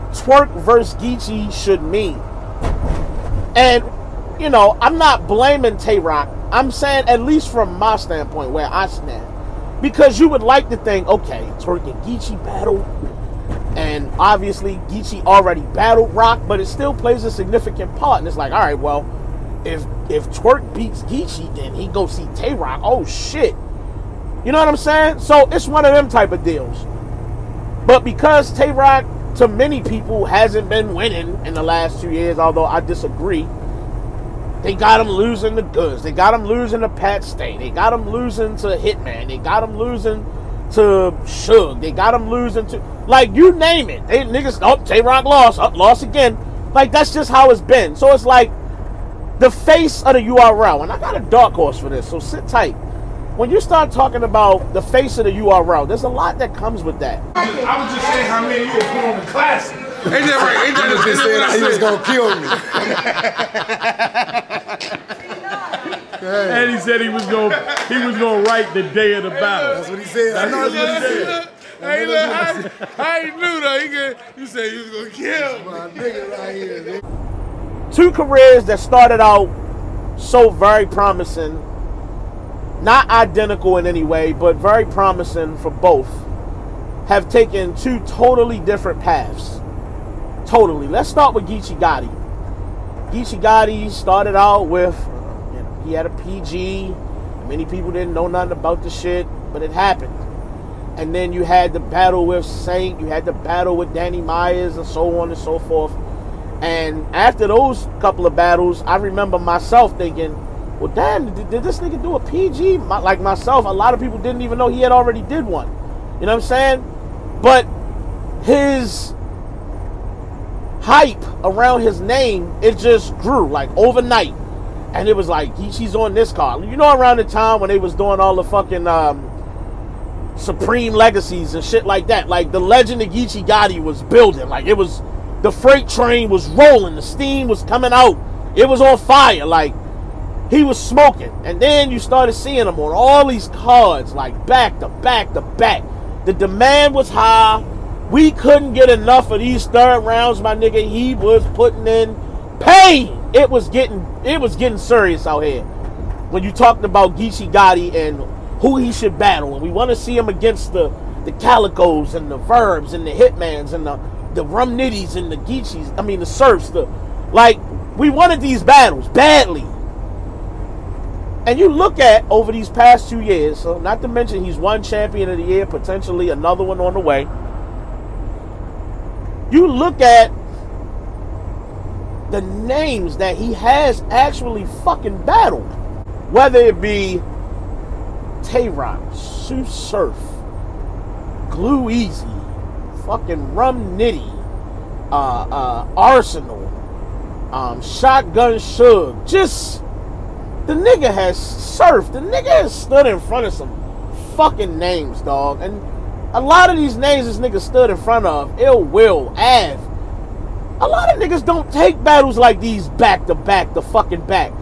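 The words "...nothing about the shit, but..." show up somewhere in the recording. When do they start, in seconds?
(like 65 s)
98 s.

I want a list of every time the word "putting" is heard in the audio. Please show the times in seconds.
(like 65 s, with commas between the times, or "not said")
58 s, 151 s.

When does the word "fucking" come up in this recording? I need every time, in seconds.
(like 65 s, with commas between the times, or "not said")
128 s, 184 s, 193 s, 204 s, 213 s.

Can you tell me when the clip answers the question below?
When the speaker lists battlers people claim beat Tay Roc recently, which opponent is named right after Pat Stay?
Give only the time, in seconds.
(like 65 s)
38 s.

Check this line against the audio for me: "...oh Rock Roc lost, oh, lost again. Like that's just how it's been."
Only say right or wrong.
wrong.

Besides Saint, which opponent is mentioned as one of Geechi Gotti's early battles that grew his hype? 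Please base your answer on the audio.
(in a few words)
Danny Myers.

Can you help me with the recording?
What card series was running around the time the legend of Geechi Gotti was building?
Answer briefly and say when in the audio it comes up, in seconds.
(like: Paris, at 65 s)
Supreme Legacies, at 130 s.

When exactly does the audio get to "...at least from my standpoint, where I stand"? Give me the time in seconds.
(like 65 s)
7 s.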